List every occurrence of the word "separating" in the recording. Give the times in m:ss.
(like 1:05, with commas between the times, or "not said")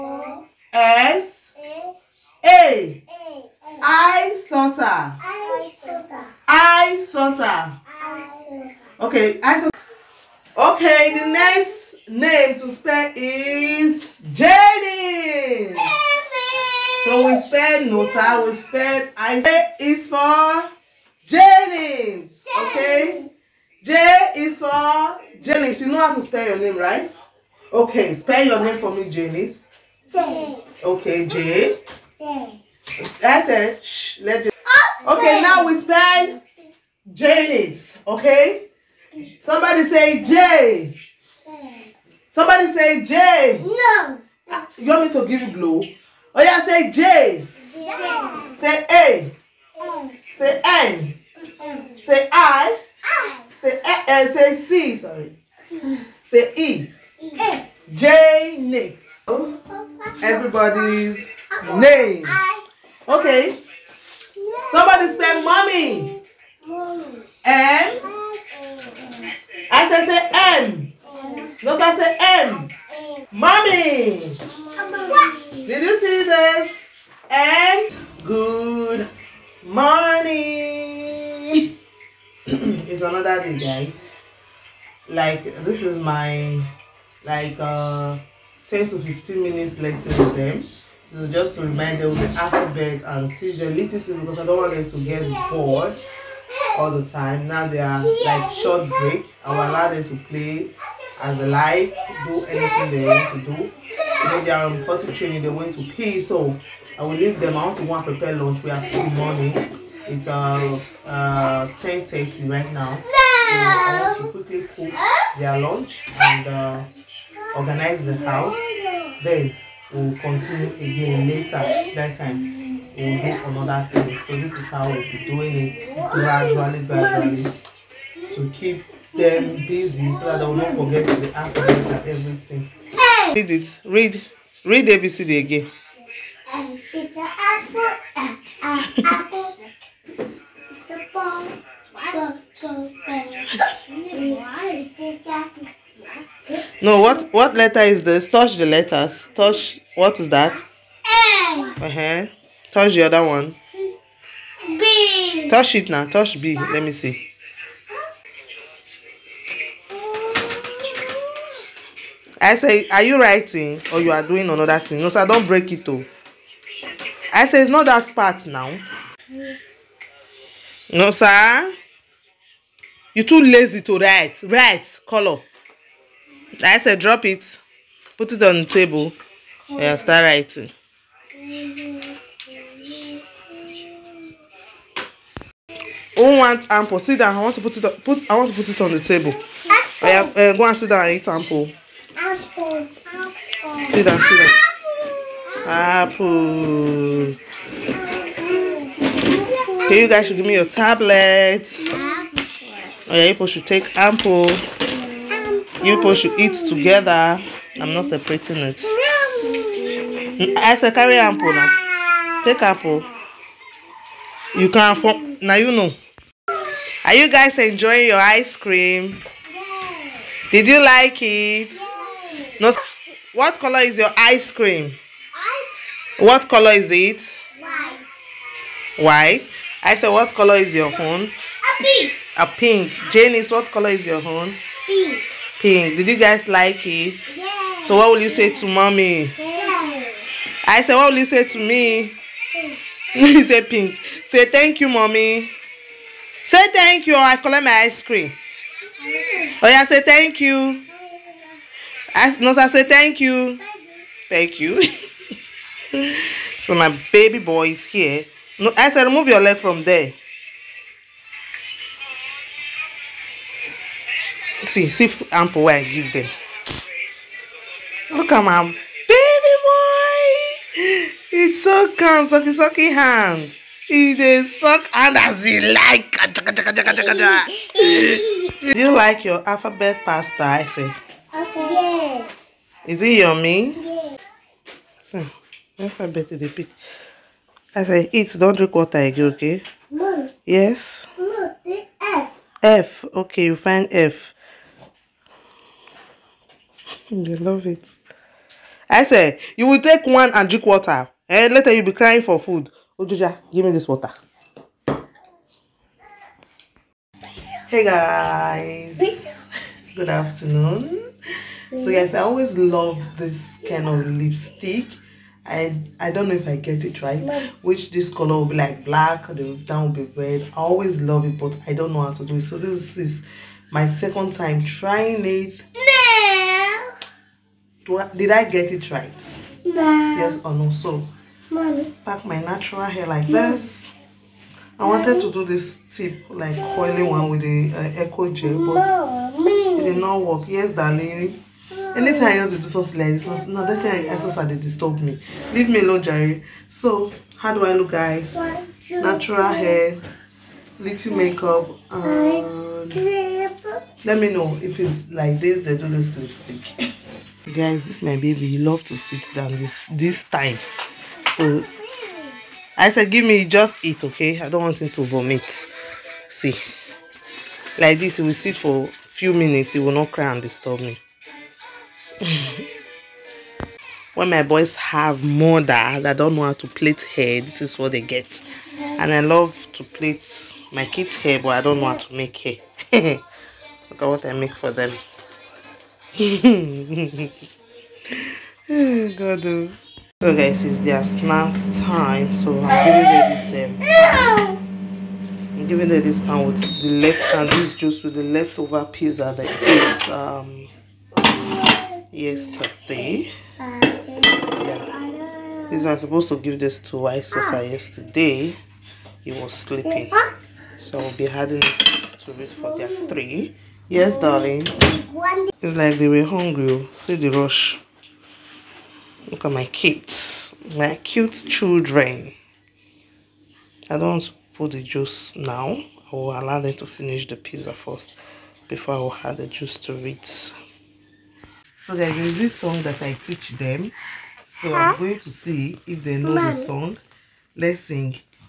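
3:28.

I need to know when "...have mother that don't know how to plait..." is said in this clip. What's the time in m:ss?
6:14.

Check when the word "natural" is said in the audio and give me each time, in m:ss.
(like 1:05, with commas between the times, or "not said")
5:32, 5:48.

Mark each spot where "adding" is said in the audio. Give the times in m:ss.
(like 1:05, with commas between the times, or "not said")
6:51.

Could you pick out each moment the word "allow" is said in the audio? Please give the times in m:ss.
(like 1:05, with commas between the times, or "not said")
1:39, 7:06.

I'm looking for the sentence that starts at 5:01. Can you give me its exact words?
and eh, Later you'll be crying for food.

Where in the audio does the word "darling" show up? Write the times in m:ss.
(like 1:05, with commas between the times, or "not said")
5:40, 6:54.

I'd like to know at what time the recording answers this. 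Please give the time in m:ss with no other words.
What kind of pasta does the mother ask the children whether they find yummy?
4:39.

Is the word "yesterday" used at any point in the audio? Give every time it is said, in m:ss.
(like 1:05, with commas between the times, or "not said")
6:42, 6:47.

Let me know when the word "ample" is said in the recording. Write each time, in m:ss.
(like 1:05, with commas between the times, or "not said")
3:06, 3:11, 3:23, 3:31, 4:25.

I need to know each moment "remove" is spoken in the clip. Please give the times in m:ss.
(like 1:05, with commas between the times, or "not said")
4:19.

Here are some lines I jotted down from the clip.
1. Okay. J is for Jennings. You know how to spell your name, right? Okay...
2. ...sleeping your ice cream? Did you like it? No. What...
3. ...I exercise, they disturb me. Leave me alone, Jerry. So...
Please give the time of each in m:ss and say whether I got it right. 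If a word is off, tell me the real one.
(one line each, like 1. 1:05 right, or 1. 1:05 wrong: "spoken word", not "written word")
1. 0:22 right
2. 3:37 wrong: "enjoying", not "sleeping"
3. 5:44 right.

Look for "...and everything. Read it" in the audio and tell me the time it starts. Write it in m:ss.
2:11.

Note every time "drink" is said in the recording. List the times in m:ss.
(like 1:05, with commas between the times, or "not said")
4:48, 5:00.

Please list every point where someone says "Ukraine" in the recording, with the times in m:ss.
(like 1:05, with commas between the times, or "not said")
not said.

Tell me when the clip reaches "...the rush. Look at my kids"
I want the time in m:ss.
6:57.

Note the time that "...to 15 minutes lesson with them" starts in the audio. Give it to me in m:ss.
1:28.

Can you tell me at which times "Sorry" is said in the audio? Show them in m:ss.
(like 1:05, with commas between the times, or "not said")
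0:54.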